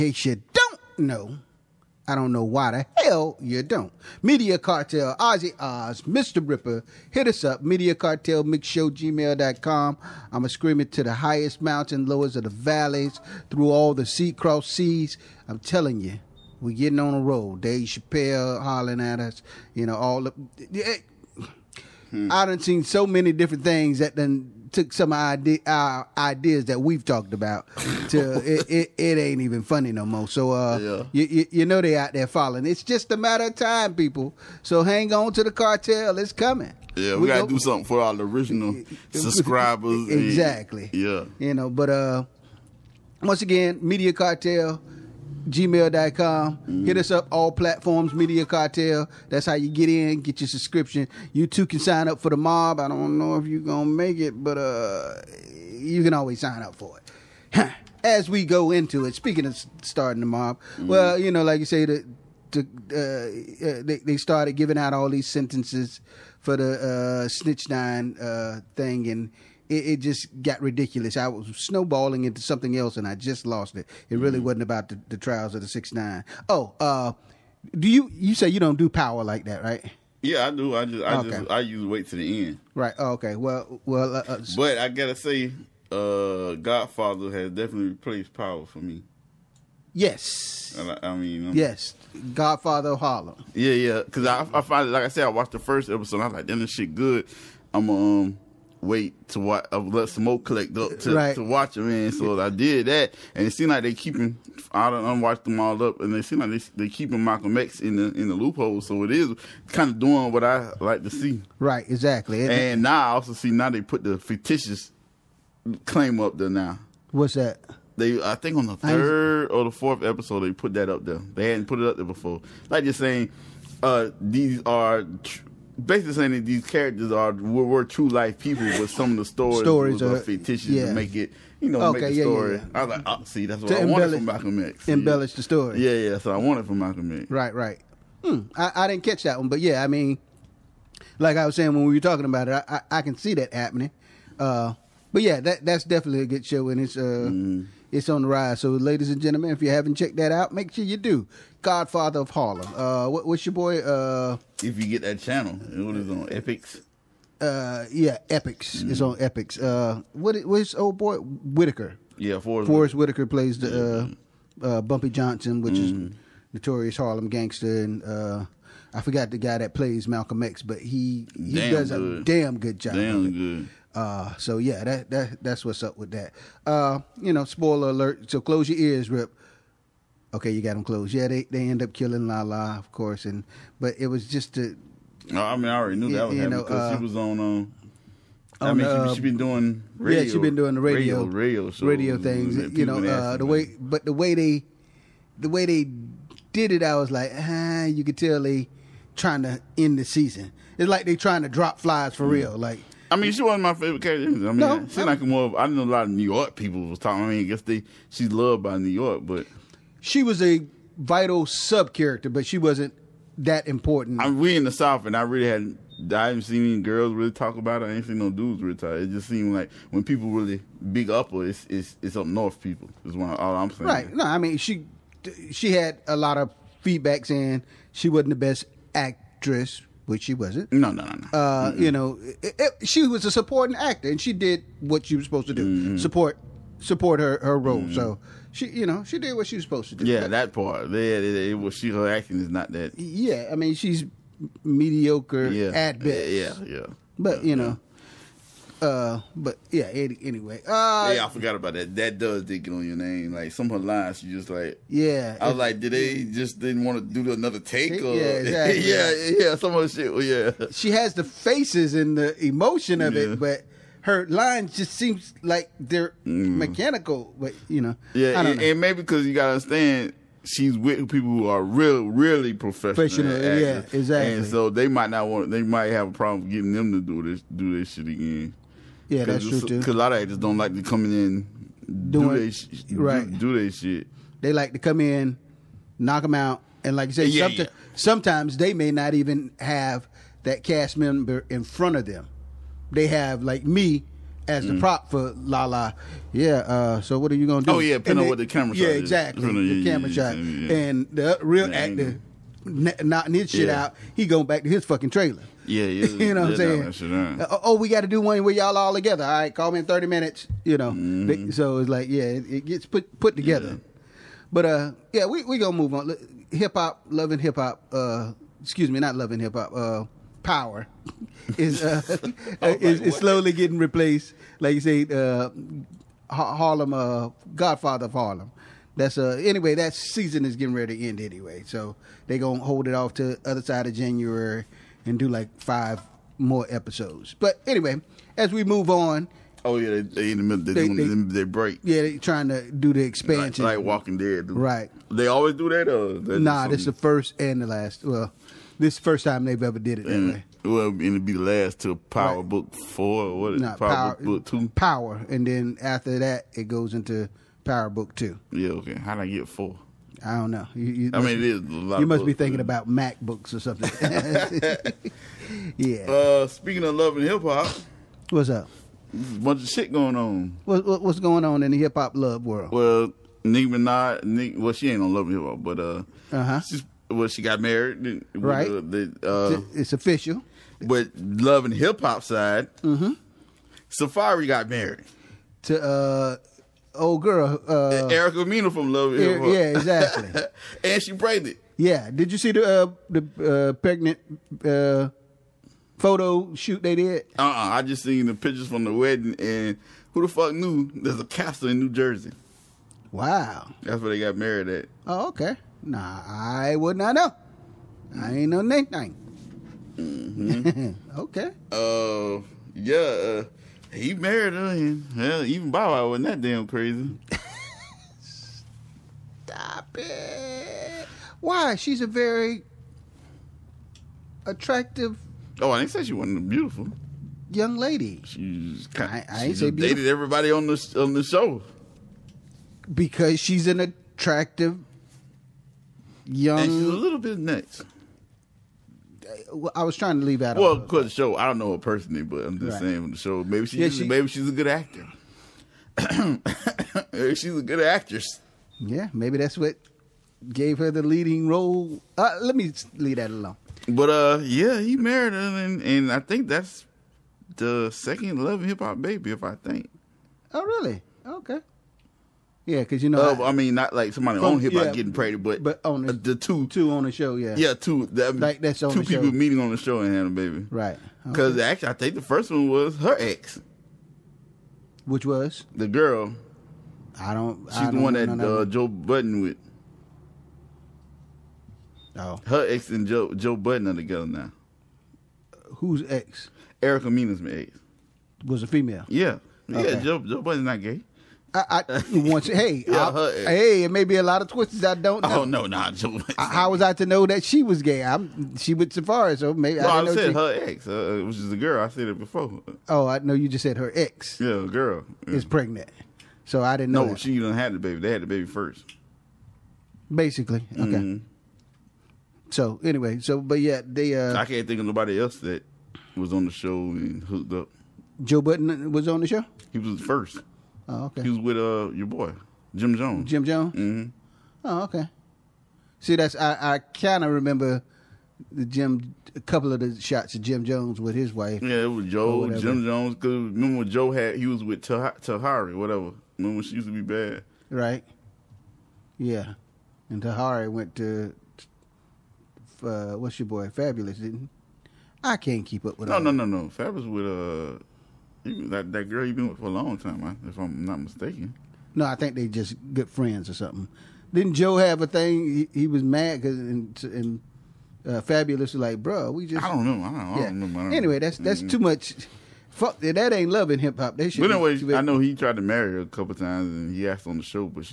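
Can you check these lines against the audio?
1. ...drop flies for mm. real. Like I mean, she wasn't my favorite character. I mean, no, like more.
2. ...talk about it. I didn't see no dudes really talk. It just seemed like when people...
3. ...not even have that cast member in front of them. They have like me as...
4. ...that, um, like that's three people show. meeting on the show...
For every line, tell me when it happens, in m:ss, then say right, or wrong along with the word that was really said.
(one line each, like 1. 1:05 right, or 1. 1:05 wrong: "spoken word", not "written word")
1. 3:21 right
2. 3:37 right
3. 4:48 right
4. 7:48 wrong: "two", not "three".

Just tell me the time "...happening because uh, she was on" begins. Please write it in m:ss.
3:06.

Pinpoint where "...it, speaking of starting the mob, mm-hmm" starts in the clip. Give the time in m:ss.
0:59.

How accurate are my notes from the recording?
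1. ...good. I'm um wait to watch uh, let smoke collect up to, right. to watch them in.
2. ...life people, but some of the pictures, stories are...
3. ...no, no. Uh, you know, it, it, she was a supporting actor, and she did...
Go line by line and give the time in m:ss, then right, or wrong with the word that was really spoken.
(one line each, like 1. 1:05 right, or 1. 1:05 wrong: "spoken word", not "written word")
1. 1:36 right
2. 2:08 wrong: "stories", not "pictures"
3. 3:51 right.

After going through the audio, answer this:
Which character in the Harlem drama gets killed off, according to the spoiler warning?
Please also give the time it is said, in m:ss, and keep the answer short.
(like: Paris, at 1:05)
Lala, at 3:02.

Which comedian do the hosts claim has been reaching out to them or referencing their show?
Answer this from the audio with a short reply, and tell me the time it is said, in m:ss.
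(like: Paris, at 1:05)
Dave Chappelle, at 0:17.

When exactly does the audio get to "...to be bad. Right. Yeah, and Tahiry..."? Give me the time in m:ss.
8:56.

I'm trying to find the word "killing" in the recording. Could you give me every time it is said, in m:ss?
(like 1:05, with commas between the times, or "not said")
3:01.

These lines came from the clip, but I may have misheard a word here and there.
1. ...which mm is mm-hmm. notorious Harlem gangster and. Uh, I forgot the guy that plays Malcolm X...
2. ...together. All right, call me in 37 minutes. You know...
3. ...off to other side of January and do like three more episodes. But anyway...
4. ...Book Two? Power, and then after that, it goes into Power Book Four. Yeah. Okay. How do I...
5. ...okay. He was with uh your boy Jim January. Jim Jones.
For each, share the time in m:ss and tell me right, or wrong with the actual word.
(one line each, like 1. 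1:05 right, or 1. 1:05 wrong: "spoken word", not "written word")
1. 2:45 right
2. 5:08 wrong: "30", not "37"
3. 5:32 wrong: "five", not "three"
4. 5:54 wrong: "Two", not "Four"
5. 8:41 wrong: "Jones", not "January".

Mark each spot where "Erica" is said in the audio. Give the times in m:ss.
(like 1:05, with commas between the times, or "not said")
6:28, 8:06.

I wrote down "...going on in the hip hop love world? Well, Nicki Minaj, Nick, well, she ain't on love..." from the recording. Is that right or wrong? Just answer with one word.
right.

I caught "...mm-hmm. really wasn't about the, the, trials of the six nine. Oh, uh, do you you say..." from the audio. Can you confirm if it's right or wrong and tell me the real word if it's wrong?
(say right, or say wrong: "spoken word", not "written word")
right.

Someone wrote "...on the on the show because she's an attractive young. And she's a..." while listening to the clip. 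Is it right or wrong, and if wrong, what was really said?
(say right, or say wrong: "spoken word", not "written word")
right.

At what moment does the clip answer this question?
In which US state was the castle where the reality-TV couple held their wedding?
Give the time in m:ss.
6:41.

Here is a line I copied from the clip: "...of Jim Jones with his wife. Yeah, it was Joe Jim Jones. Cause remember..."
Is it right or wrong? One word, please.
right.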